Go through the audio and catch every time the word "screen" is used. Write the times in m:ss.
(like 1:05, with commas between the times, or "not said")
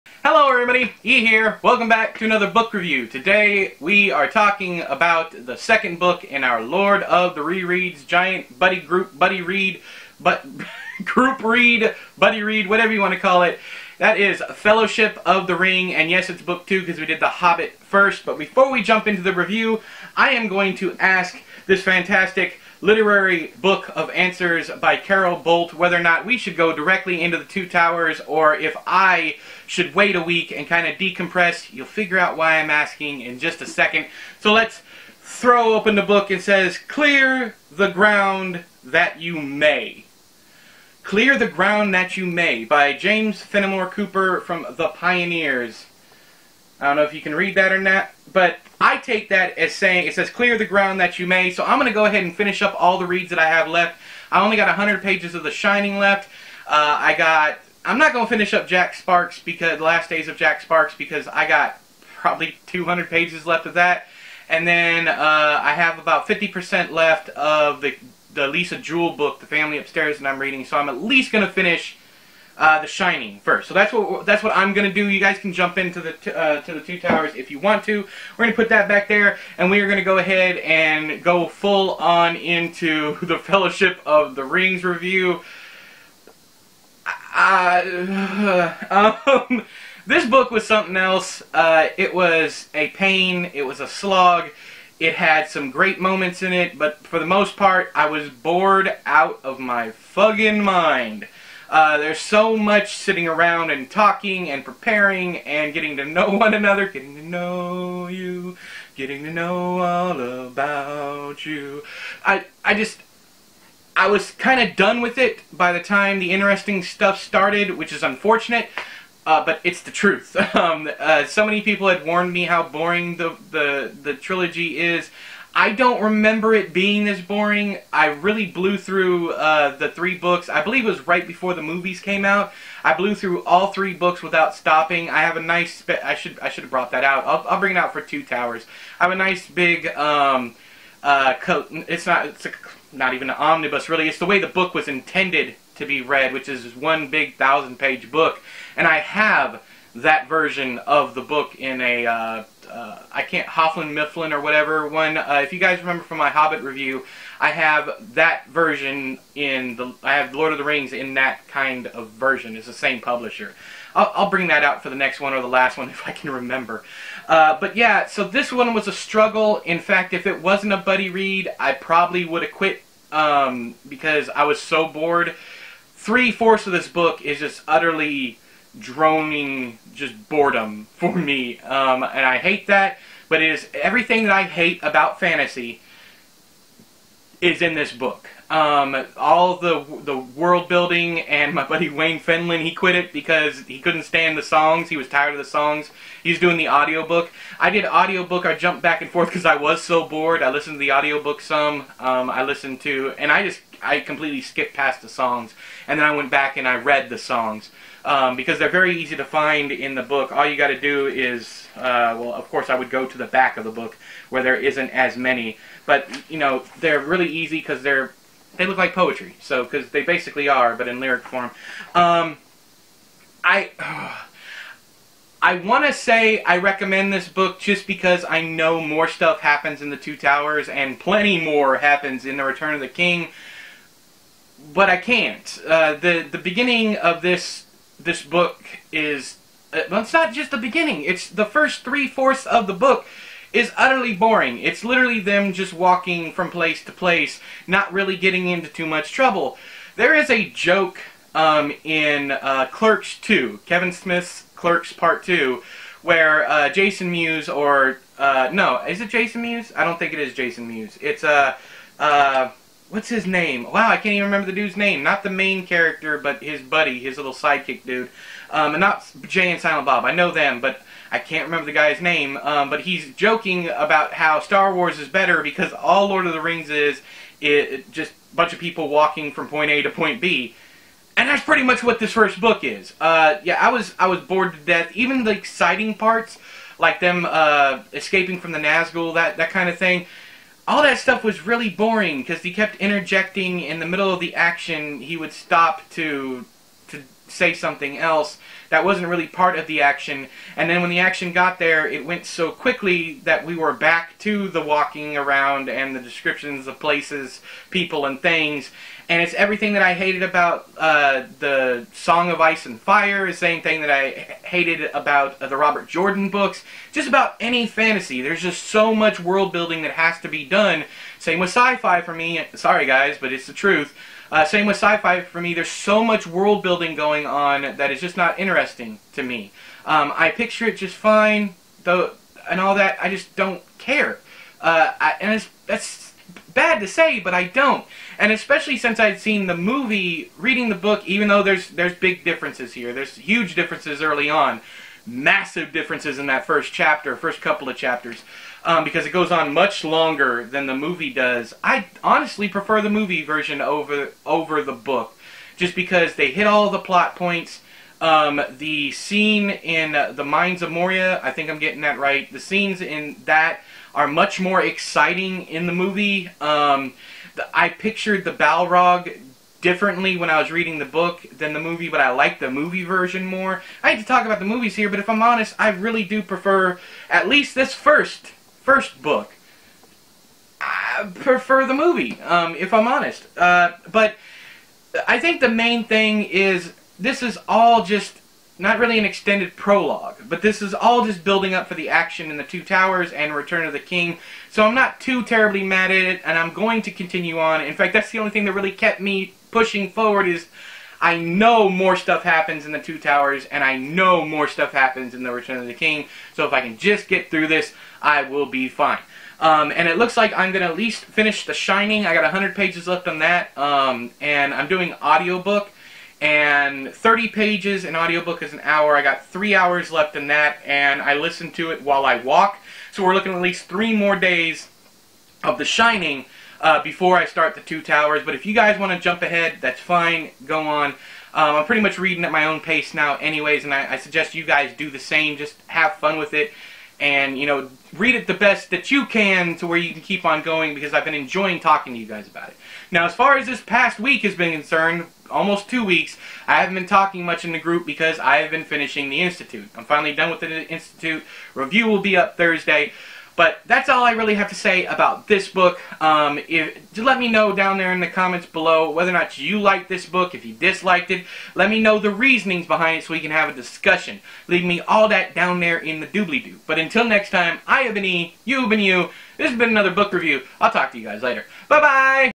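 not said.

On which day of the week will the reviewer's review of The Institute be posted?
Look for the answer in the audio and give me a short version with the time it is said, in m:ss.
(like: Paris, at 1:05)
Thursday, at 7:32.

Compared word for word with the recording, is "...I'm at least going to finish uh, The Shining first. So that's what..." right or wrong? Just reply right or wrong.
right.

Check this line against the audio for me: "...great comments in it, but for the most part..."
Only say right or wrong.
wrong.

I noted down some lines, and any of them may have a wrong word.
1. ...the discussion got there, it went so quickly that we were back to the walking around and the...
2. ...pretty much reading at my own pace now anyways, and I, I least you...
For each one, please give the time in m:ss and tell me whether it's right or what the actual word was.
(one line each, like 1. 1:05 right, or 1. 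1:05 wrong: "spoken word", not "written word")
1. 5:00 wrong: "action", not "discussion"
2. 7:11 wrong: "suggest", not "least".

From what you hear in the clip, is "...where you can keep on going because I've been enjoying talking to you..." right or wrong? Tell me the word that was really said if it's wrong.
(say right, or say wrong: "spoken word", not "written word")
right.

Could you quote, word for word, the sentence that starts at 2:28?
And I have that version of the book in a uh, uh, I can't Hofflin Mifflin or whatever one.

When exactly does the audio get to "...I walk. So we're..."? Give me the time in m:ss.
7:02.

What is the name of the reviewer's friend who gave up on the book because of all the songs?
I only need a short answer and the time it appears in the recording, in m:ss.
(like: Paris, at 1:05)
Wayne Fenlon, at 3:11.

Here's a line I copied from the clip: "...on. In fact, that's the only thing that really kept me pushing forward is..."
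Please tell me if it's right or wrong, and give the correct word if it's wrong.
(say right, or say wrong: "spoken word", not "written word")
right.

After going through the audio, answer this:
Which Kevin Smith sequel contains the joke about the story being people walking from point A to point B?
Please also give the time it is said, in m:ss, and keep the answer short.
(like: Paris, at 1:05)
Clerks 2, at 4:12.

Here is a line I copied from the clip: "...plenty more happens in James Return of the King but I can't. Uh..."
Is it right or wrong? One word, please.
wrong.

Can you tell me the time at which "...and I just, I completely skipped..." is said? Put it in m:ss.
3:23.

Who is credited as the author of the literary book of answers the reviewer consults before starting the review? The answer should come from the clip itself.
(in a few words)
Carol Bolt.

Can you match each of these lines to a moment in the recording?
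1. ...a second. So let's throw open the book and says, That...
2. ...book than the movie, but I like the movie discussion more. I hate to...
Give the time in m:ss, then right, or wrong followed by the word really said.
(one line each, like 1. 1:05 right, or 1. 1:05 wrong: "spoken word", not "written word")
1. 0:33 wrong: "Clear", not "That"
2. 6:10 wrong: "version", not "discussion".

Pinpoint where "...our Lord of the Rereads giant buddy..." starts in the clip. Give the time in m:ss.
0:06.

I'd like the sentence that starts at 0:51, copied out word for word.
So I'm going to go ahead and finish up all the reads that I have left.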